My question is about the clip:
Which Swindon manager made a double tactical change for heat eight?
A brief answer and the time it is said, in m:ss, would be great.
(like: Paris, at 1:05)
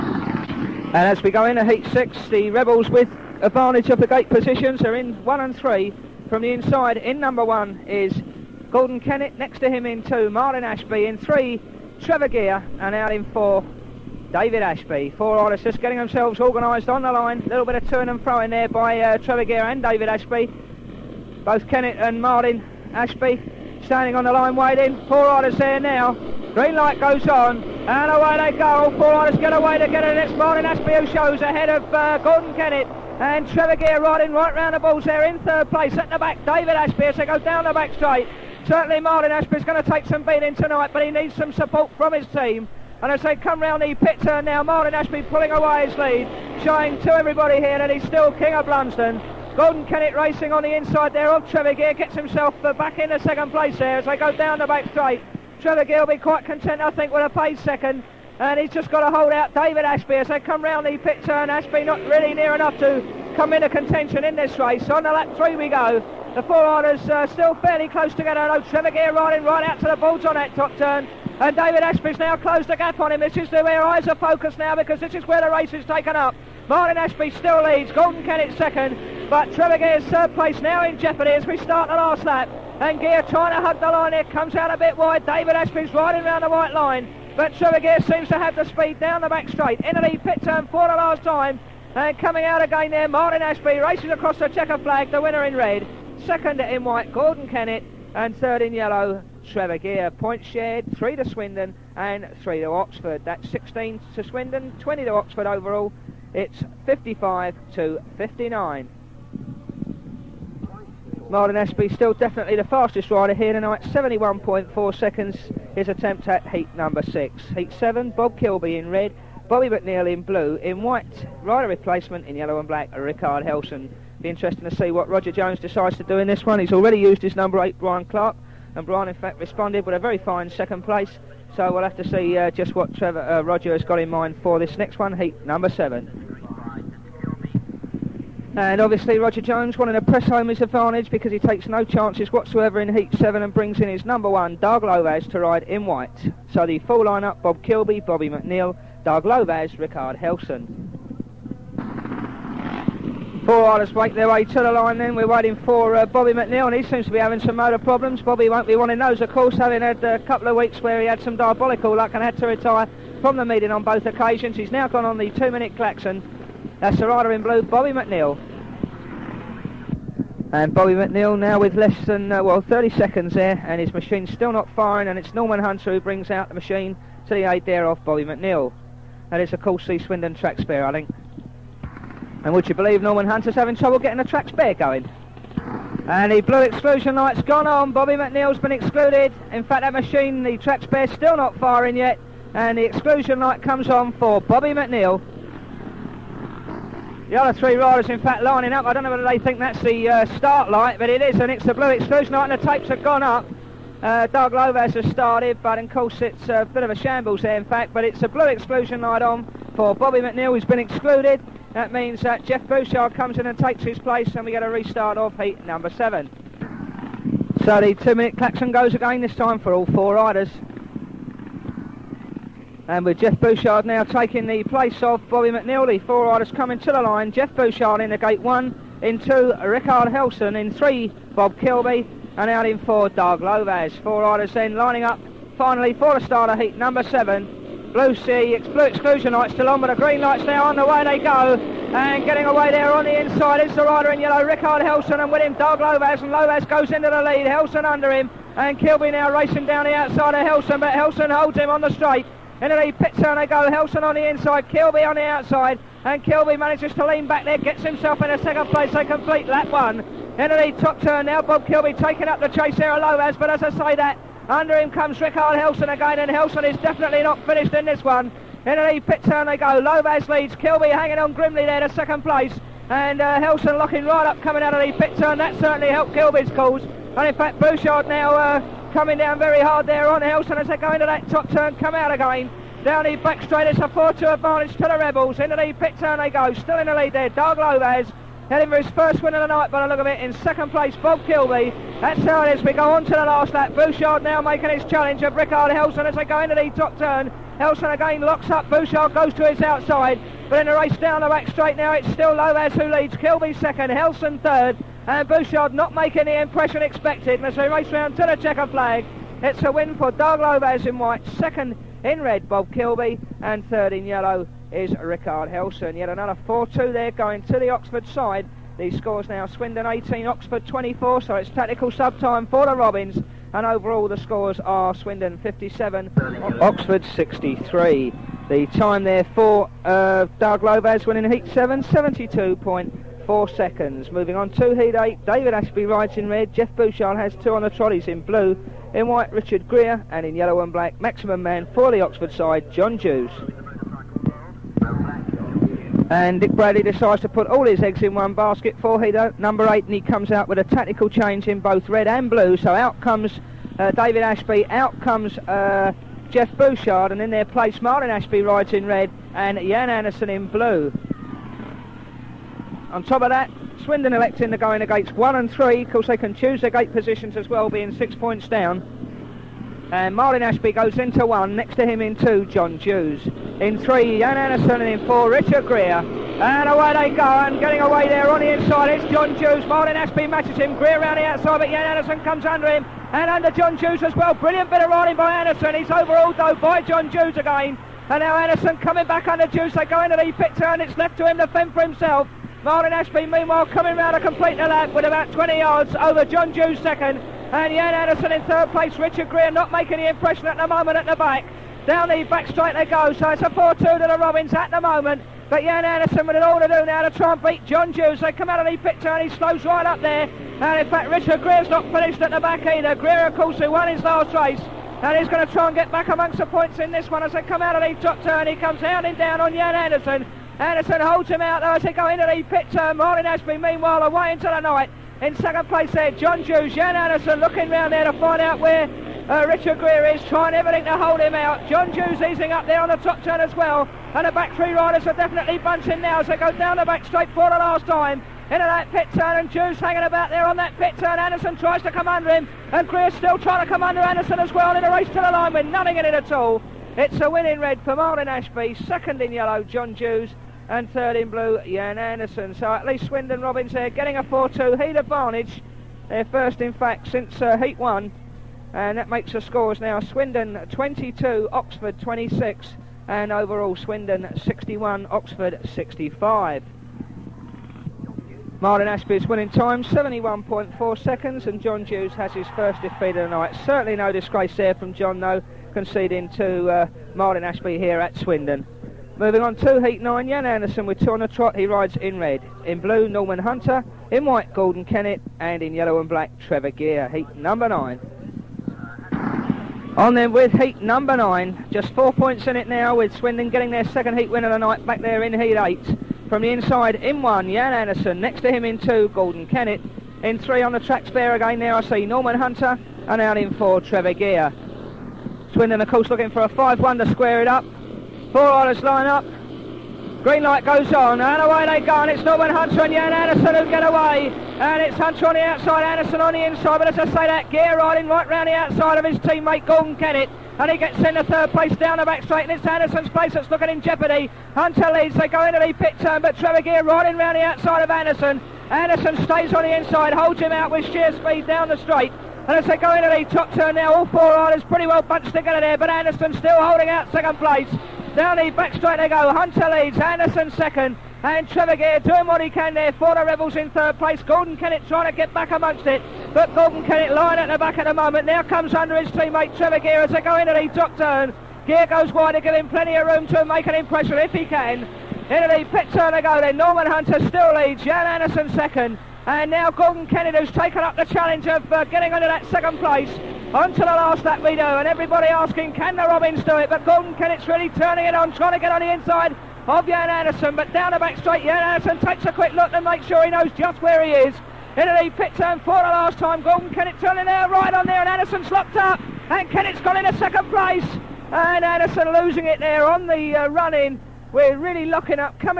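Dick Bradley, at 5:46.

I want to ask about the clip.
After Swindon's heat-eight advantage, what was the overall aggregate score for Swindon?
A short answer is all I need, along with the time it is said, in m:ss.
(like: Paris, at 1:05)
61, at 7:43.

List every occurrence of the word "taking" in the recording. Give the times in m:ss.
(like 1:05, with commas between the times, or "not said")
3:44, 4:21.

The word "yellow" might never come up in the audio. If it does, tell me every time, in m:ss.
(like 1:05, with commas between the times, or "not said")
1:38, 2:02, 4:04, 5:14, 5:40, 7:29, 8:05.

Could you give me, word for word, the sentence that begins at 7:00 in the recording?
Anderson holds him out though as they go into the pit turn.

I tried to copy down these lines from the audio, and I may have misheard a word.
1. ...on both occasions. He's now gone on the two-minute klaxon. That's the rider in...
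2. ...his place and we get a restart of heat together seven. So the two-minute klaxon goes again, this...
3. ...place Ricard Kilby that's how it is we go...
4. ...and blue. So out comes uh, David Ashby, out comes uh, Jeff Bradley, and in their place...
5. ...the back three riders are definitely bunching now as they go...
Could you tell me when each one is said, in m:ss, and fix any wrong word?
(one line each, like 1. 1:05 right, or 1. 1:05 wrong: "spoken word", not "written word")
1. 2:43 right
2. 3:33 wrong: "number", not "together"
3. 4:50 wrong: "Bob", not "Ricard"
4. 5:52 wrong: "Bouchard", not "Bradley"
5. 7:14 right.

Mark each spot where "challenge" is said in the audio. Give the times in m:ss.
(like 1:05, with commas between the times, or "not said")
4:54, 9:21.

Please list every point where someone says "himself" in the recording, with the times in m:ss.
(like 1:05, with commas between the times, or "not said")
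0:52, 4:17, 6:31.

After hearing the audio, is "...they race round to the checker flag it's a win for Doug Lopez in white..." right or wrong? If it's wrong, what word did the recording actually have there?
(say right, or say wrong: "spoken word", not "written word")
right.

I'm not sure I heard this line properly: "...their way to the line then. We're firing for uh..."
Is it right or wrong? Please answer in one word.
wrong.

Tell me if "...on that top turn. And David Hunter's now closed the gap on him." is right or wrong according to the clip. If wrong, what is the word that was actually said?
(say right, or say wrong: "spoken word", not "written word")
wrong: "Ashby", not "Hunter".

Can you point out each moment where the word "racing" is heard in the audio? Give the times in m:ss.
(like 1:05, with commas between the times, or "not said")
0:50, 4:09.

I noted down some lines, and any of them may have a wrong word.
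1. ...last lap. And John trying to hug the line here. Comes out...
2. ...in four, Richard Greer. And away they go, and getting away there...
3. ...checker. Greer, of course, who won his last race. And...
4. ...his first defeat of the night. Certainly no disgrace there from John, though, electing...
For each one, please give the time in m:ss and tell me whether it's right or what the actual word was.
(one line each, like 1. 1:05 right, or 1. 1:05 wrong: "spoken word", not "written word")
1. 1:21 wrong: "Geer", not "John"
2. 6:15 right
3. 6:52 wrong: "either", not "checker"
4. 7:52 wrong: "conceding", not "electing".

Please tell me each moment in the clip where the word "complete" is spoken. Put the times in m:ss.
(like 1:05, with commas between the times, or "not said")
4:19, 6:34.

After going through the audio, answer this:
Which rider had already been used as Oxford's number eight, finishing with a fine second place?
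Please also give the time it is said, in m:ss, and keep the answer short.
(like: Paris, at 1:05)
Brian Clark, at 2:07.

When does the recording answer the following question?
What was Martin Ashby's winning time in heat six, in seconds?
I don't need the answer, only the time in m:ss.
1:53.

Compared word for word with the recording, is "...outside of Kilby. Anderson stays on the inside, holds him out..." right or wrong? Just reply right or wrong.
wrong.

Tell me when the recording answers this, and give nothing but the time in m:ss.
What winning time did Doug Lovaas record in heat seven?
5:31.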